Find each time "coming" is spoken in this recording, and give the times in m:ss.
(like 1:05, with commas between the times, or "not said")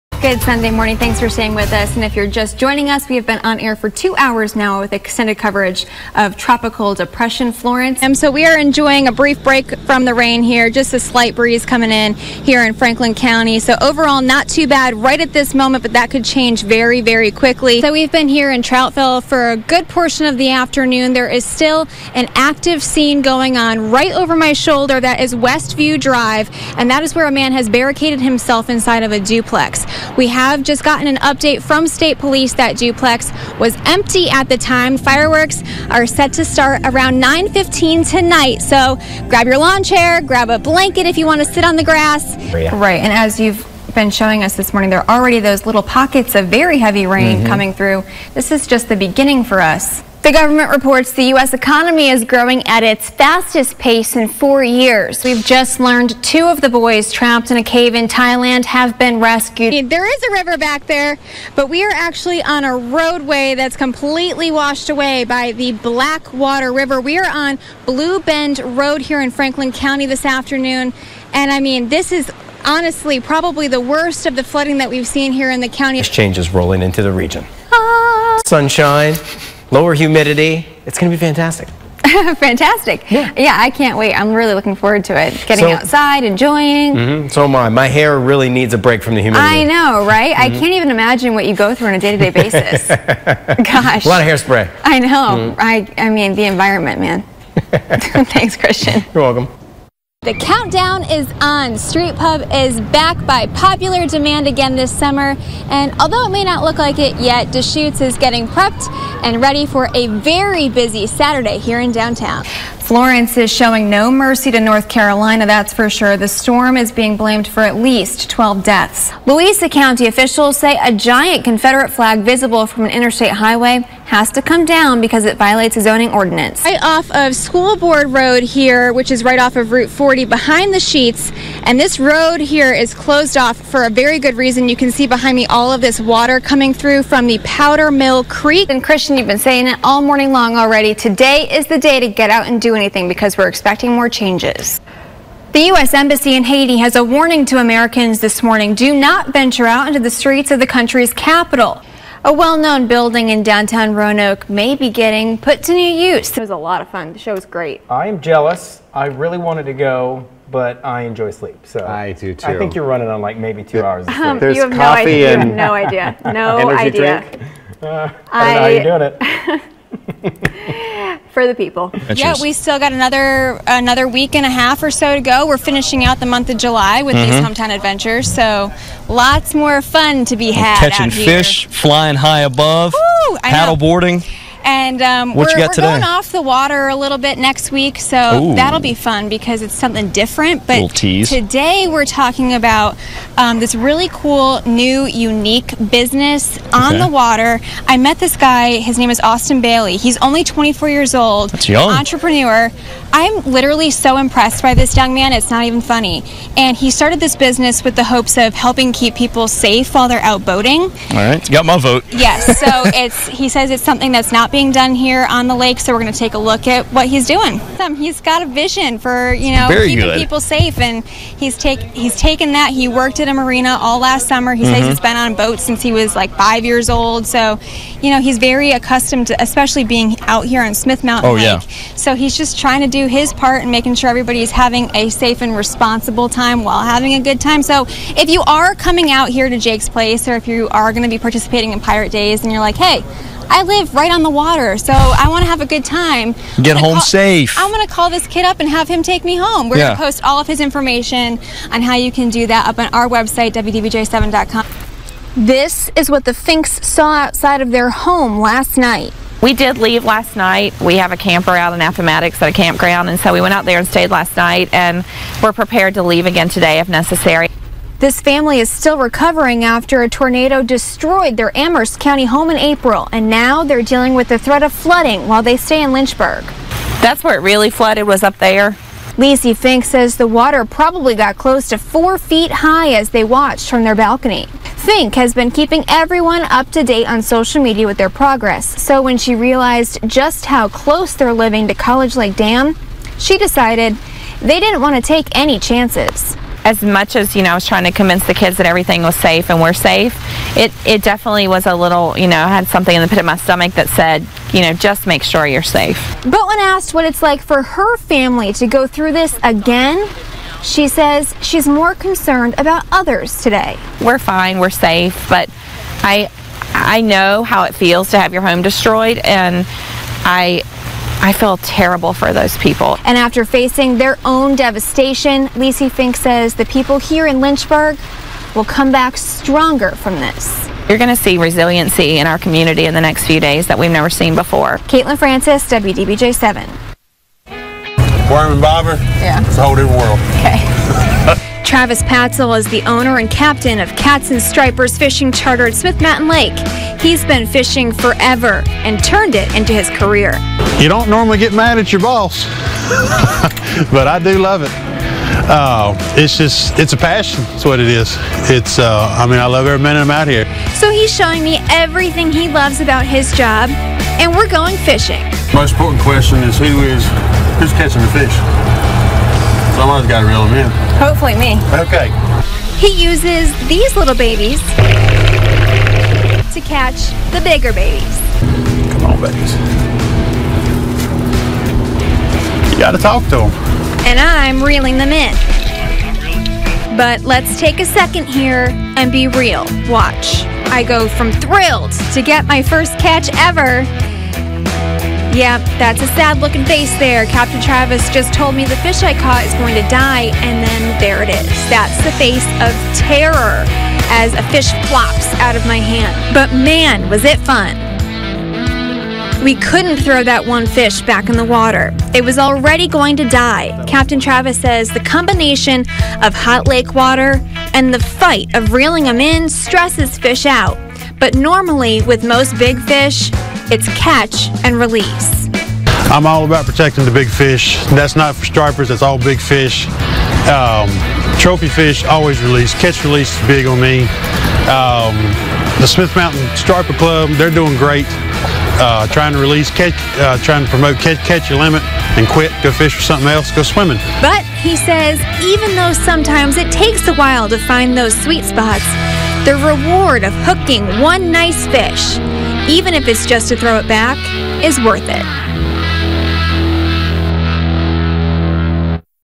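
0:11, 0:47, 2:16, 3:58.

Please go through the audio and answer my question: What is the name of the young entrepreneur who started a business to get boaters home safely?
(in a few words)
Austin Bailey.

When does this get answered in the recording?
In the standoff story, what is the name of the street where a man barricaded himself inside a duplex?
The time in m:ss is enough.
0:25.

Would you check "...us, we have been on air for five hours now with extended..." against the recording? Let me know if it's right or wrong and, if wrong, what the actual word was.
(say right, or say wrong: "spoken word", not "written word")
wrong: "two", not "five".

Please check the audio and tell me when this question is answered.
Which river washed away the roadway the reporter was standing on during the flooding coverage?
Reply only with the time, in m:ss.
1:05.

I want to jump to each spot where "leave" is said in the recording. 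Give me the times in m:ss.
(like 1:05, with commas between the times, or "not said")
4:19, 4:26.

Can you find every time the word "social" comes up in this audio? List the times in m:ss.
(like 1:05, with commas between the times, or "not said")
4:47.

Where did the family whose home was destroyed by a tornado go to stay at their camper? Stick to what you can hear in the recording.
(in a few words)
Appomattox.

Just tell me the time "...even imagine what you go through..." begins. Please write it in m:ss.
1:30.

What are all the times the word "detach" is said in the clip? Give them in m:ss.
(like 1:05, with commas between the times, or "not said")
not said.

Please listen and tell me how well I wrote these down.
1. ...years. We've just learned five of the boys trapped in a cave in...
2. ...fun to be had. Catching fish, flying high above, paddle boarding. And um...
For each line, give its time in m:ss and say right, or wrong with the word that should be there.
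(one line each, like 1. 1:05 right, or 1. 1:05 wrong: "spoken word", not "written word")
1. 0:54 wrong: "two", not "five"
2. 2:59 right.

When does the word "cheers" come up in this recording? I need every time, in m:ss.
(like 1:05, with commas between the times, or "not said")
2:52.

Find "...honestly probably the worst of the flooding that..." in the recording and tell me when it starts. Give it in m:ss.
1:12.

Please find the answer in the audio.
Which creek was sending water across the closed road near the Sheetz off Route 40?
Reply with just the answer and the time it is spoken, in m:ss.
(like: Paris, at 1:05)
Powder Mill Creek, at 2:17.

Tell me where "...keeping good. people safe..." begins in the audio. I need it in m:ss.
3:39.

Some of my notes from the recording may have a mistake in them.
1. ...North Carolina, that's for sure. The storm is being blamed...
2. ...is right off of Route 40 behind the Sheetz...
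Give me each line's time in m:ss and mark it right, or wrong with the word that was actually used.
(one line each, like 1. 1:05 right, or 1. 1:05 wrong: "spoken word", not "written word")
1. 1:54 right
2. 2:09 right.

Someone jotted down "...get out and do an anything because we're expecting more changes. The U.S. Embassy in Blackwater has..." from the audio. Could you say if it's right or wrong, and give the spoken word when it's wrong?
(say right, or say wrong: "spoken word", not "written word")
wrong: "Haiti", not "Blackwater".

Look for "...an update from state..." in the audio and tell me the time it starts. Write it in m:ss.
0:31.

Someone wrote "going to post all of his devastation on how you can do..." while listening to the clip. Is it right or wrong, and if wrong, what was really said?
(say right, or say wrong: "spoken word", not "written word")
wrong: "information", not "devastation".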